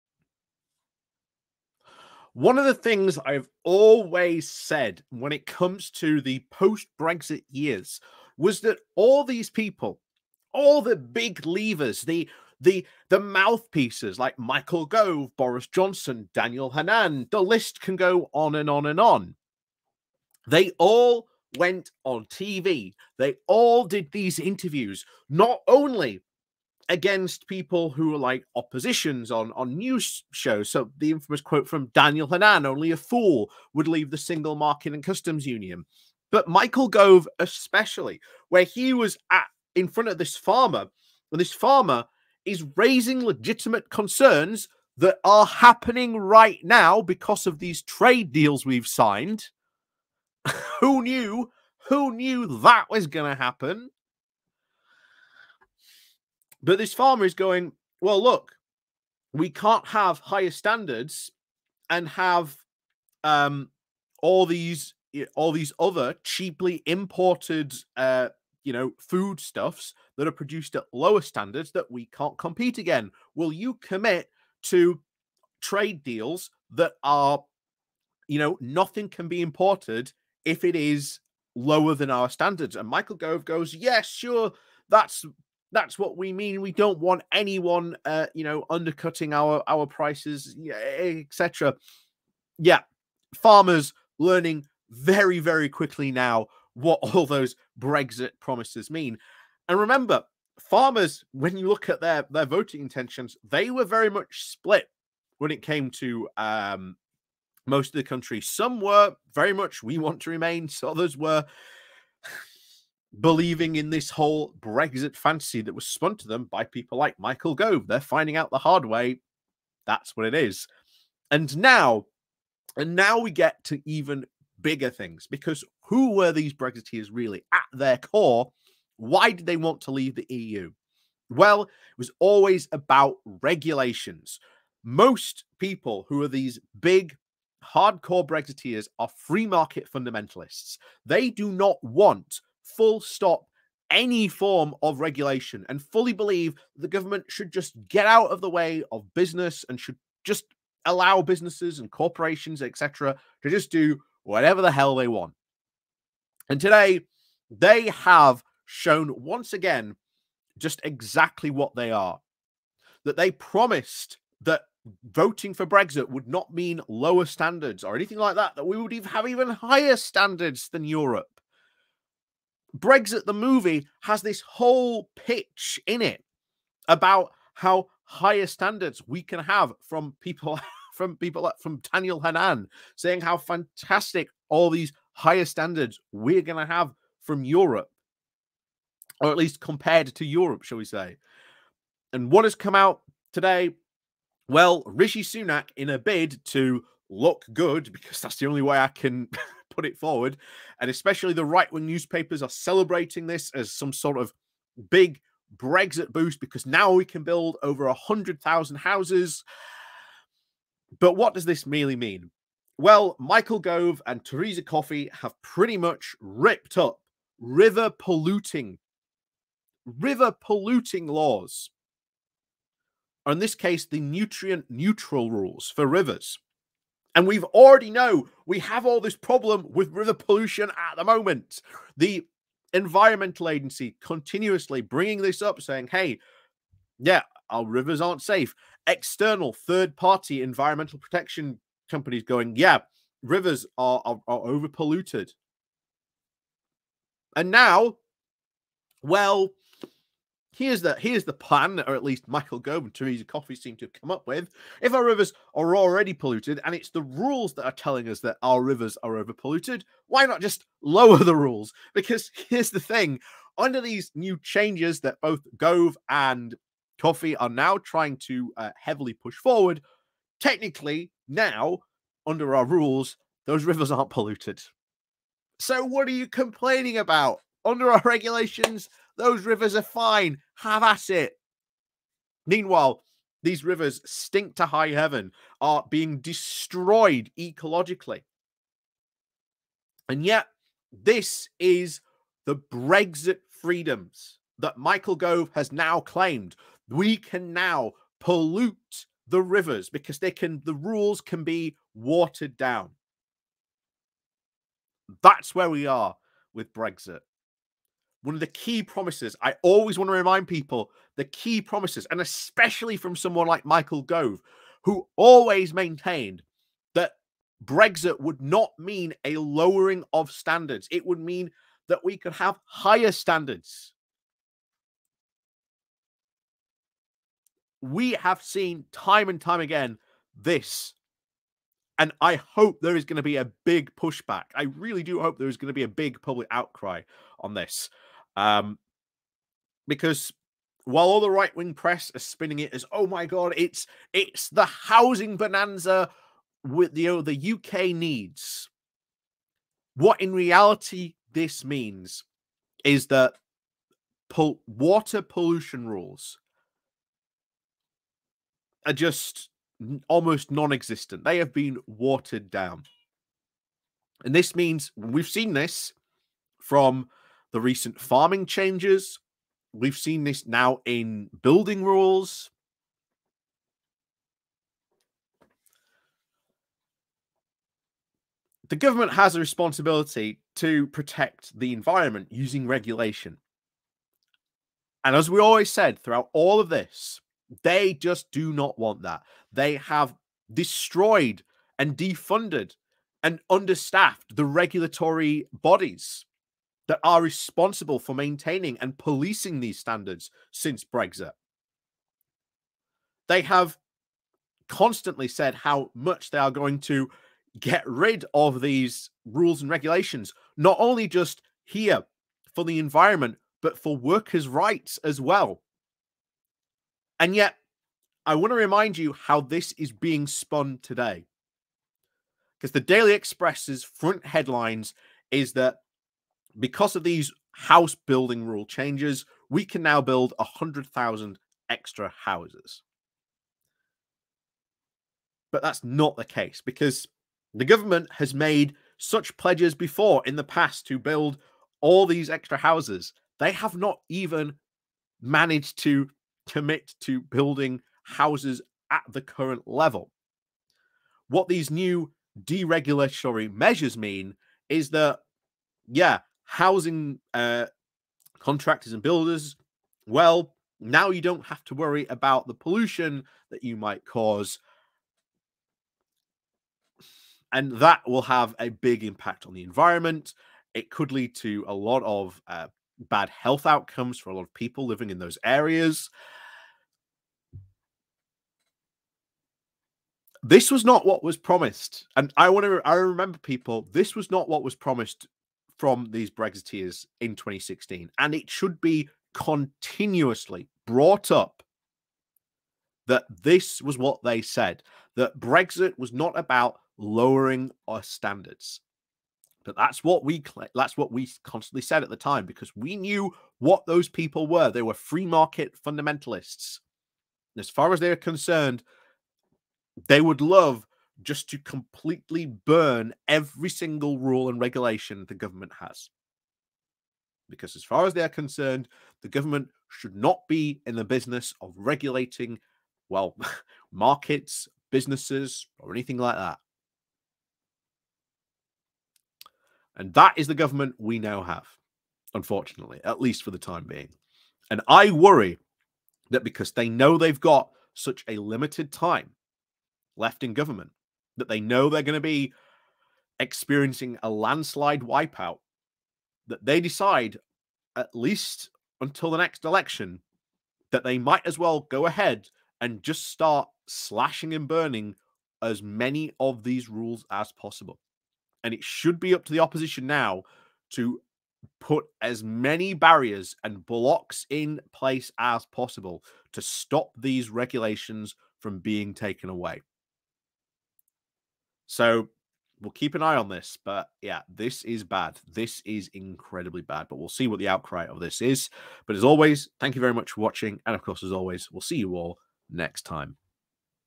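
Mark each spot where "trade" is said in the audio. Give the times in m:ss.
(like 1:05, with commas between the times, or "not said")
0:47, 1:15.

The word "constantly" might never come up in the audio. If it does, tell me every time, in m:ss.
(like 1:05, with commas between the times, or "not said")
6:44, 8:21.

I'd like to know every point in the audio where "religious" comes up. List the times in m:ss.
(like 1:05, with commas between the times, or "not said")
not said.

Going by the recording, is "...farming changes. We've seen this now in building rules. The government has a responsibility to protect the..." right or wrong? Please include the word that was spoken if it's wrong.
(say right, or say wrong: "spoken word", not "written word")
right.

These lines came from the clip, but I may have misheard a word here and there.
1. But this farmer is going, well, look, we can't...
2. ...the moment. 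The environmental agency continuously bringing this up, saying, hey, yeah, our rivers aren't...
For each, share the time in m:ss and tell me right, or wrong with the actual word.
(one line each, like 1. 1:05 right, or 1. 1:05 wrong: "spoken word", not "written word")
1. 0:56 right
2. 3:50 right.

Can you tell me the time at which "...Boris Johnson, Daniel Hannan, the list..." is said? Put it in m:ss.
0:15.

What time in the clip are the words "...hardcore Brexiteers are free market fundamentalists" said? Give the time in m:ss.
2:17.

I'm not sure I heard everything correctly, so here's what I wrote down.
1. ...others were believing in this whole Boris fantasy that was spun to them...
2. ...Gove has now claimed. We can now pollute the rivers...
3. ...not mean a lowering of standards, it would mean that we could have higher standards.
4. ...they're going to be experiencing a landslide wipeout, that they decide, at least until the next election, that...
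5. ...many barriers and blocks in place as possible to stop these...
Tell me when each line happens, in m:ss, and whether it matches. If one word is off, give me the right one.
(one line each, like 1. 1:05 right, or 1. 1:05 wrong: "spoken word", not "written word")
1. 1:50 wrong: "Brexit", not "Boris"
2. 4:55 right
3. 5:18 right
4. 9:01 right
5. 9:22 right.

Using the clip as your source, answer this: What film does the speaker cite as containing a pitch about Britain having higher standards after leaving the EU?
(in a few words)
Brexit the movie.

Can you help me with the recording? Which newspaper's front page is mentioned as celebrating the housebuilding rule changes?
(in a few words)
Daily Express.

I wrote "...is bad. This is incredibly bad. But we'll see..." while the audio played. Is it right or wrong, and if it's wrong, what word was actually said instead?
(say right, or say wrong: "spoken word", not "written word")
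right.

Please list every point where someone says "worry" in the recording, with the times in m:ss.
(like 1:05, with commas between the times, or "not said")
7:41, 8:55.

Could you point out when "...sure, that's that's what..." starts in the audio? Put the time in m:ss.
1:24.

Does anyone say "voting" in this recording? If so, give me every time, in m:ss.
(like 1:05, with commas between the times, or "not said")
1:42, 2:45.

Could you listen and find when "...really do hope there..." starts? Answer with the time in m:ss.
5:34.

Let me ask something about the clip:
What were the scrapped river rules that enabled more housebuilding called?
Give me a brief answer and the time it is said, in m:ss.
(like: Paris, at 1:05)
nutrient neutral rules, at 3:43.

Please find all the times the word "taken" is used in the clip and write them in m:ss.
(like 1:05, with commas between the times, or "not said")
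9:29.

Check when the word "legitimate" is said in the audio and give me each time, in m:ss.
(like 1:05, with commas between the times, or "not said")
0:43.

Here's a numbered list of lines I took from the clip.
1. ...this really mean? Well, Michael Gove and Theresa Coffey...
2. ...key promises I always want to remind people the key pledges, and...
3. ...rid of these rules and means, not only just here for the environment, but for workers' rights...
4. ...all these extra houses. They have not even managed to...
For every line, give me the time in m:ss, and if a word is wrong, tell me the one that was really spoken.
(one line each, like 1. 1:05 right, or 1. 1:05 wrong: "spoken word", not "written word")
1. 3:31 right
2. 5:08 wrong: "promises", not "pledges"
3. 6:47 wrong: "regulations", not "means"
4. 7:21 right.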